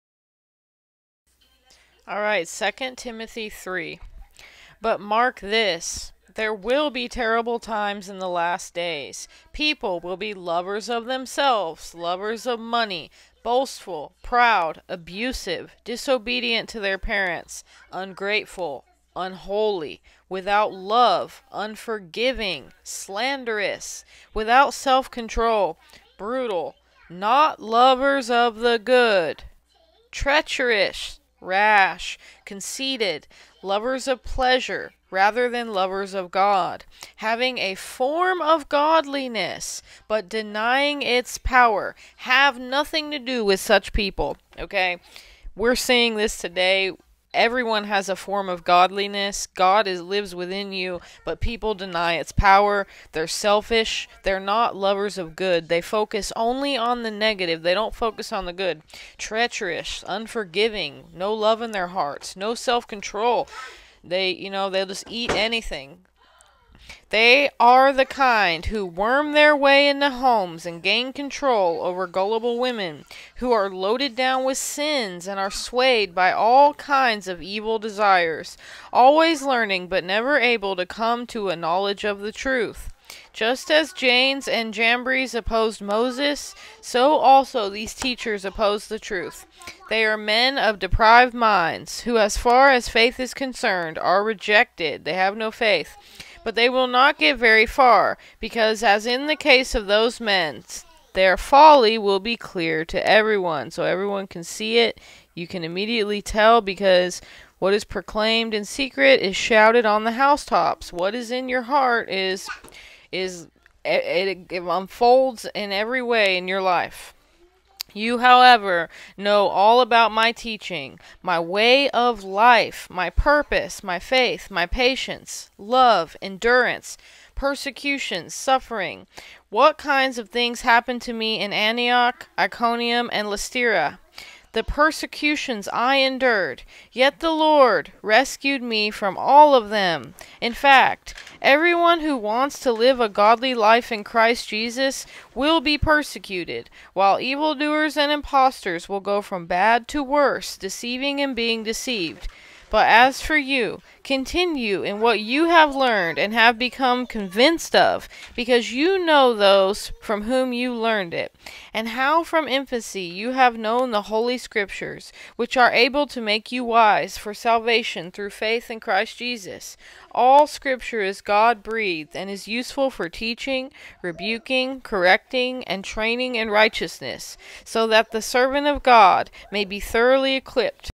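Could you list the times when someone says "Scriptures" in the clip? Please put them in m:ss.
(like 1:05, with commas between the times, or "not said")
2:44, 2:50.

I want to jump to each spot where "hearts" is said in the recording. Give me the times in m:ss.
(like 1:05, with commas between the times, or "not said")
1:01, 1:51.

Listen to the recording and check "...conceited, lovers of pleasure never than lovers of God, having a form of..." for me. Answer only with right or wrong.
wrong.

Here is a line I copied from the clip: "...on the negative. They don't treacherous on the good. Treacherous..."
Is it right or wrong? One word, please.
wrong.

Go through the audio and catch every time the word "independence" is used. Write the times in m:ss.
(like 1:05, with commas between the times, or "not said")
not said.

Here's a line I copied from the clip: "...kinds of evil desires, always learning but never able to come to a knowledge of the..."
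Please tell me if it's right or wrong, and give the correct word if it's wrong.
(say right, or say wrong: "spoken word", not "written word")
right.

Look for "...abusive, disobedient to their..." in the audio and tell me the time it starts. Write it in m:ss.
0:14.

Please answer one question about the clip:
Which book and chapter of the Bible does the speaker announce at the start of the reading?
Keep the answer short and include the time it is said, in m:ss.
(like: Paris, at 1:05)
Second Timothy 3, at 0:02.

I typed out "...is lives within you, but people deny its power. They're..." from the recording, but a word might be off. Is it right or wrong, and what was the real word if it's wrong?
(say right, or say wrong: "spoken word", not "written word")
right.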